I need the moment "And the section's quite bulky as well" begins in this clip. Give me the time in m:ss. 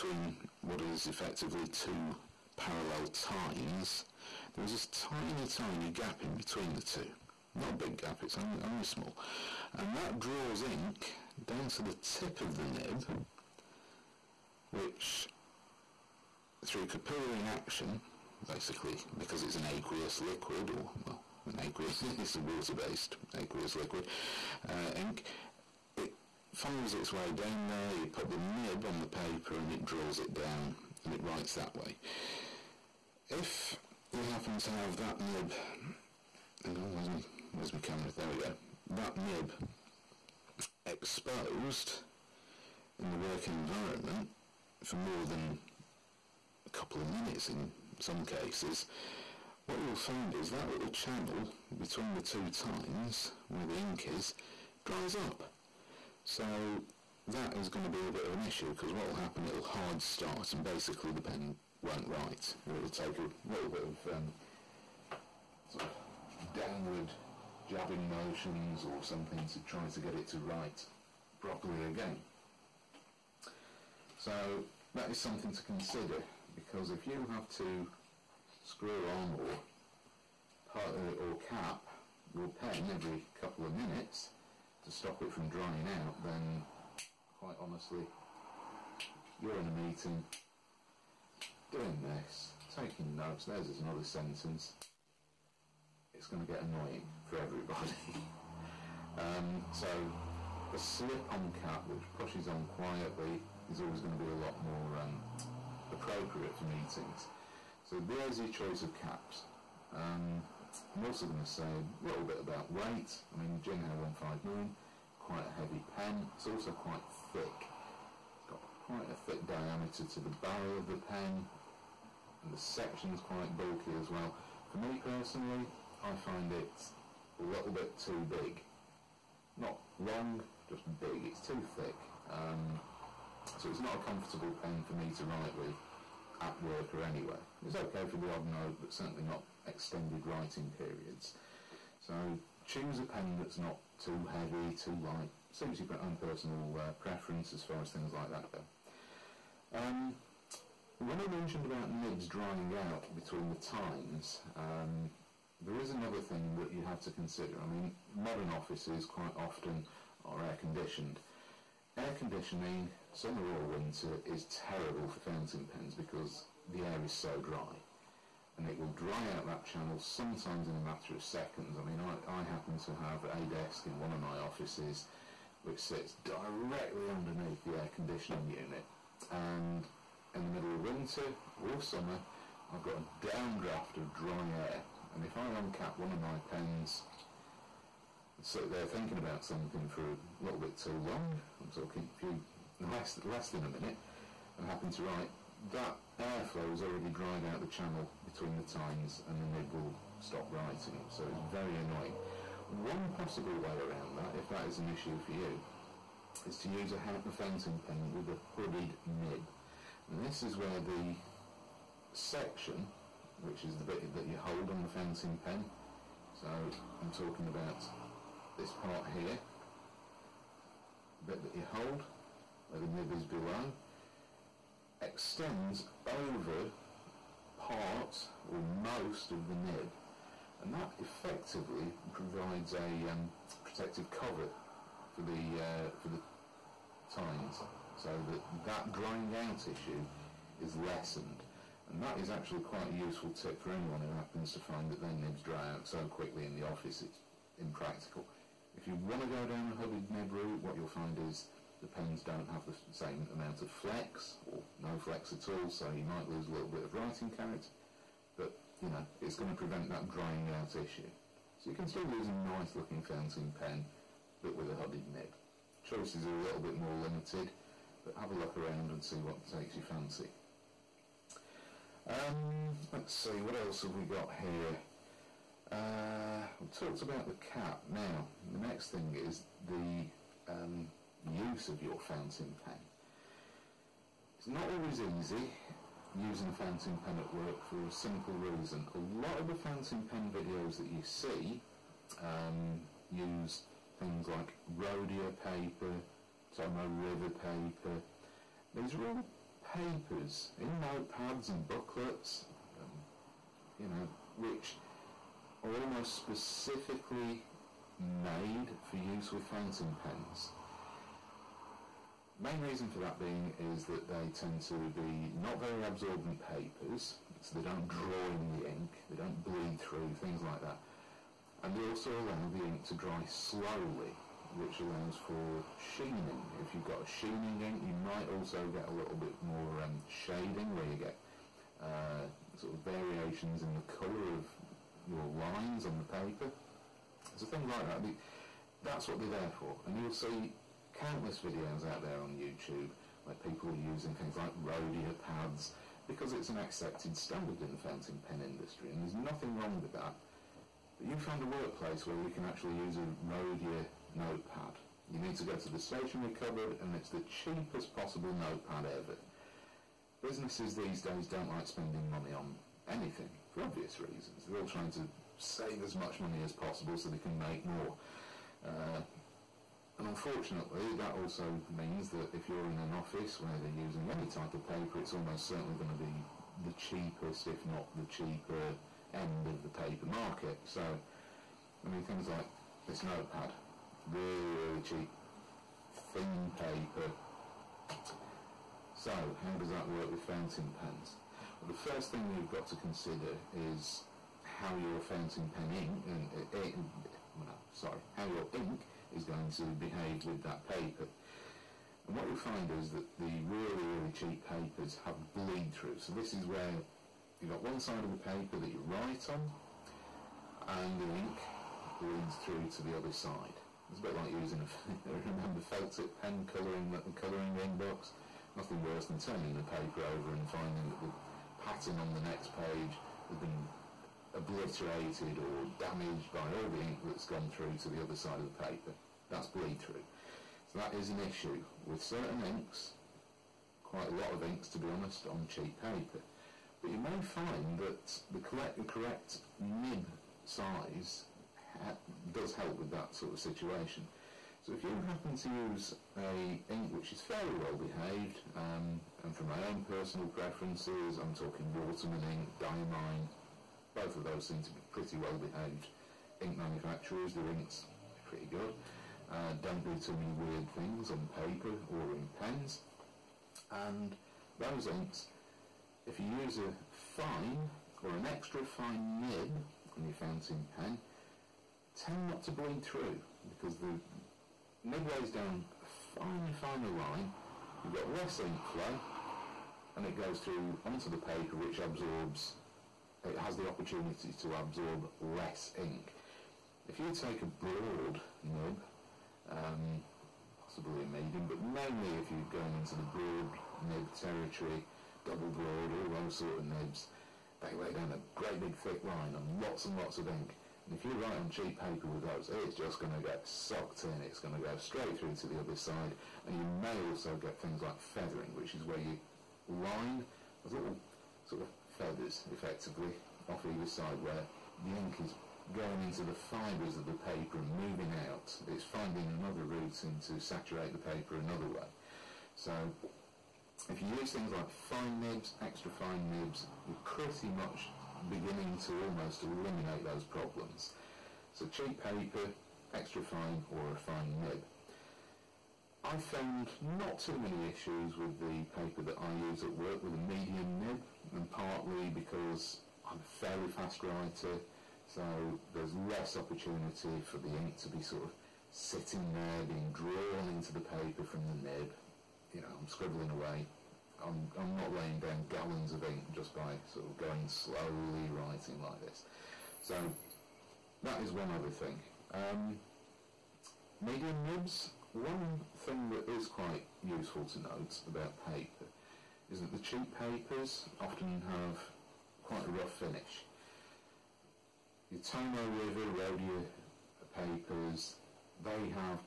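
2:02.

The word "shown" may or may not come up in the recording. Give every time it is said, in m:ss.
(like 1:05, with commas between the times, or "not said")
not said.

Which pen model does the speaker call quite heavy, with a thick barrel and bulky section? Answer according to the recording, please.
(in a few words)
Jinhao 159.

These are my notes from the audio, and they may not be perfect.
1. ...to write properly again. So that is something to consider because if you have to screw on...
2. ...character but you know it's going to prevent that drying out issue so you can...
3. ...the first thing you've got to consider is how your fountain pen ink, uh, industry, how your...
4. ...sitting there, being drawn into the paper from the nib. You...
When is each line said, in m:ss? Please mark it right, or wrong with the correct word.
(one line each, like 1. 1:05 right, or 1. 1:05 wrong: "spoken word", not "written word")
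1. 1:10 right
2. 4:17 right
3. 6:31 wrong: "sorry", not "industry"
4. 9:08 right.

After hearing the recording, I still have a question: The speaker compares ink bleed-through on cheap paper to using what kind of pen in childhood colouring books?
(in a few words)
felt tip pen.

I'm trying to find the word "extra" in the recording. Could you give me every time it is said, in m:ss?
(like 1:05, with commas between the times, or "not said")
7:48, 8:45, 8:52.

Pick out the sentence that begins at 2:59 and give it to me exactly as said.
And in the middle of winter or summer, I've got a downdraft of dry air.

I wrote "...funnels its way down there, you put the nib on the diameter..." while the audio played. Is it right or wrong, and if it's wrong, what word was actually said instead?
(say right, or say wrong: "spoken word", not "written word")
wrong: "paper", not "diameter".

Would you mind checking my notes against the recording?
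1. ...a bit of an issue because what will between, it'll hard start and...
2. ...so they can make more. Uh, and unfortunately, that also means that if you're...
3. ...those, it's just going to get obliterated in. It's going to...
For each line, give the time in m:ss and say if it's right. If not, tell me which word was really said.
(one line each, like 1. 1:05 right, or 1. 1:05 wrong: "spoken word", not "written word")
1. 0:58 wrong: "happen", not "between"
2. 6:06 right
3. 8:22 wrong: "sucked", not "obliterated".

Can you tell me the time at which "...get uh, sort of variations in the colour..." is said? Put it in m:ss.
5:30.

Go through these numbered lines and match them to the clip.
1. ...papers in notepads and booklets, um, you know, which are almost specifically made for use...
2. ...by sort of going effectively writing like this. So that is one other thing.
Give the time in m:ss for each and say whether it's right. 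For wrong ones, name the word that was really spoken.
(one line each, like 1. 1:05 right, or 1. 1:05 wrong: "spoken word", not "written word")
1. 4:59 right
2. 9:16 wrong: "slowly", not "effectively".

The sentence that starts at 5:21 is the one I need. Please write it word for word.
And they also allow the ink to dry slowly, which allows for sheening.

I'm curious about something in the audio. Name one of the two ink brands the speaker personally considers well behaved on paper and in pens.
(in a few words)
Waterman.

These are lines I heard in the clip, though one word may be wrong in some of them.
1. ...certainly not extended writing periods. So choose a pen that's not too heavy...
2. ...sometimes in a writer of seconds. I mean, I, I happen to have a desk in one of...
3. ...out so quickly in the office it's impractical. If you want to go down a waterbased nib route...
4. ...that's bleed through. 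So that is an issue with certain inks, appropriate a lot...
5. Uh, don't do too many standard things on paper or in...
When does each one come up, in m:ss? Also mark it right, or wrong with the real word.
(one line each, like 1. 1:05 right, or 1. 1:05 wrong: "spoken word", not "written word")
1. 2:18 right
2. 2:50 wrong: "matter", not "writer"
3. 4:05 wrong: "hooded", not "waterbased"
4. 7:09 wrong: "quite", not "appropriate"
5. 7:39 wrong: "weird", not "standard".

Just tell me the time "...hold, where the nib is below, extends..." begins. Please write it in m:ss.
3:41.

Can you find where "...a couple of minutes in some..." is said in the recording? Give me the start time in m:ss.
0:46.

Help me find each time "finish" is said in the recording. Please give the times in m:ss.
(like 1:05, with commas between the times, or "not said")
9:32.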